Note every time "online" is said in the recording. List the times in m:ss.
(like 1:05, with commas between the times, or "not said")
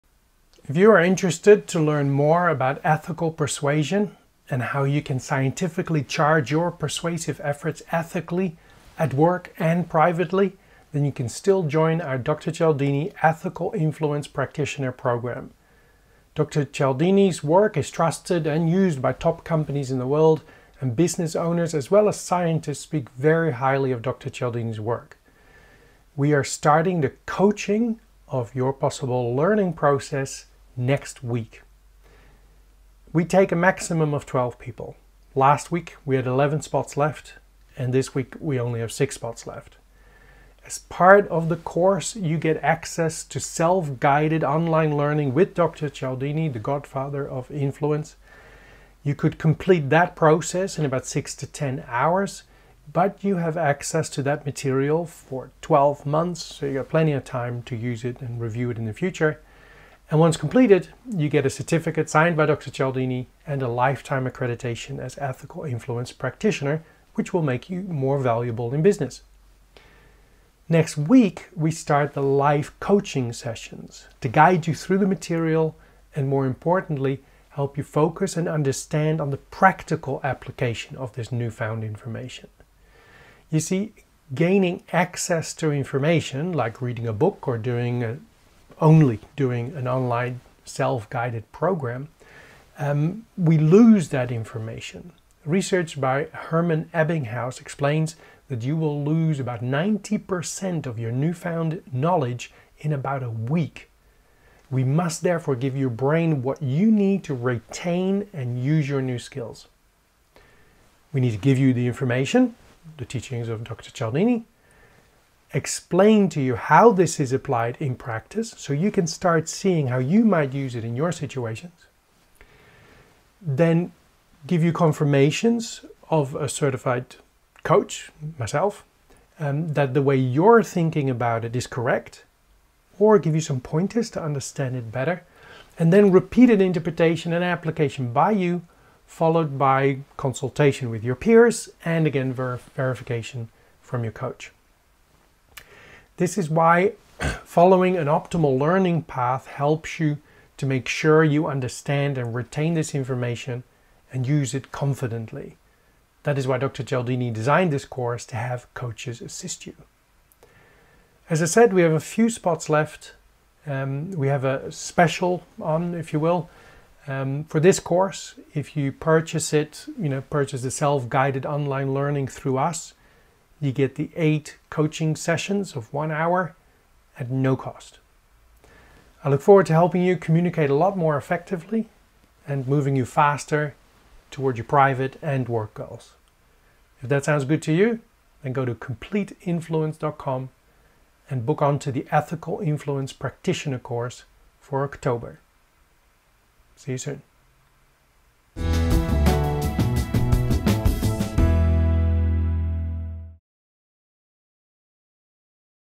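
0:44, 1:29, 2:51.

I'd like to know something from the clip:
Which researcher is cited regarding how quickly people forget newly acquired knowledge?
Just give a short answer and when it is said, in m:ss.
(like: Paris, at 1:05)
Herman Ebbinghaus, at 1:36.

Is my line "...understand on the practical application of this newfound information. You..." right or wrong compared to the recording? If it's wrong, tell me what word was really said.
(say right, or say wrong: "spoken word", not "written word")
right.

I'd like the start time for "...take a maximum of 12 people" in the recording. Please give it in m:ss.
0:33.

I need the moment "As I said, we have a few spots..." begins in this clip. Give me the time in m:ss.
2:41.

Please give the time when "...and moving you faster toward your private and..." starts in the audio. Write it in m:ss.
3:02.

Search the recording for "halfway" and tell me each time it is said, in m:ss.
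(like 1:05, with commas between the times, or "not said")
not said.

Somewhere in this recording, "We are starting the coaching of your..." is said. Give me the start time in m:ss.
0:26.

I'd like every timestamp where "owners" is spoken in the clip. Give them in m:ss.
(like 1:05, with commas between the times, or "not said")
0:21.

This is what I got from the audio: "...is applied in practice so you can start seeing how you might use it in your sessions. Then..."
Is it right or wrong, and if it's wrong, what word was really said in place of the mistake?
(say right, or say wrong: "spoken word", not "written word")
wrong: "situations", not "sessions".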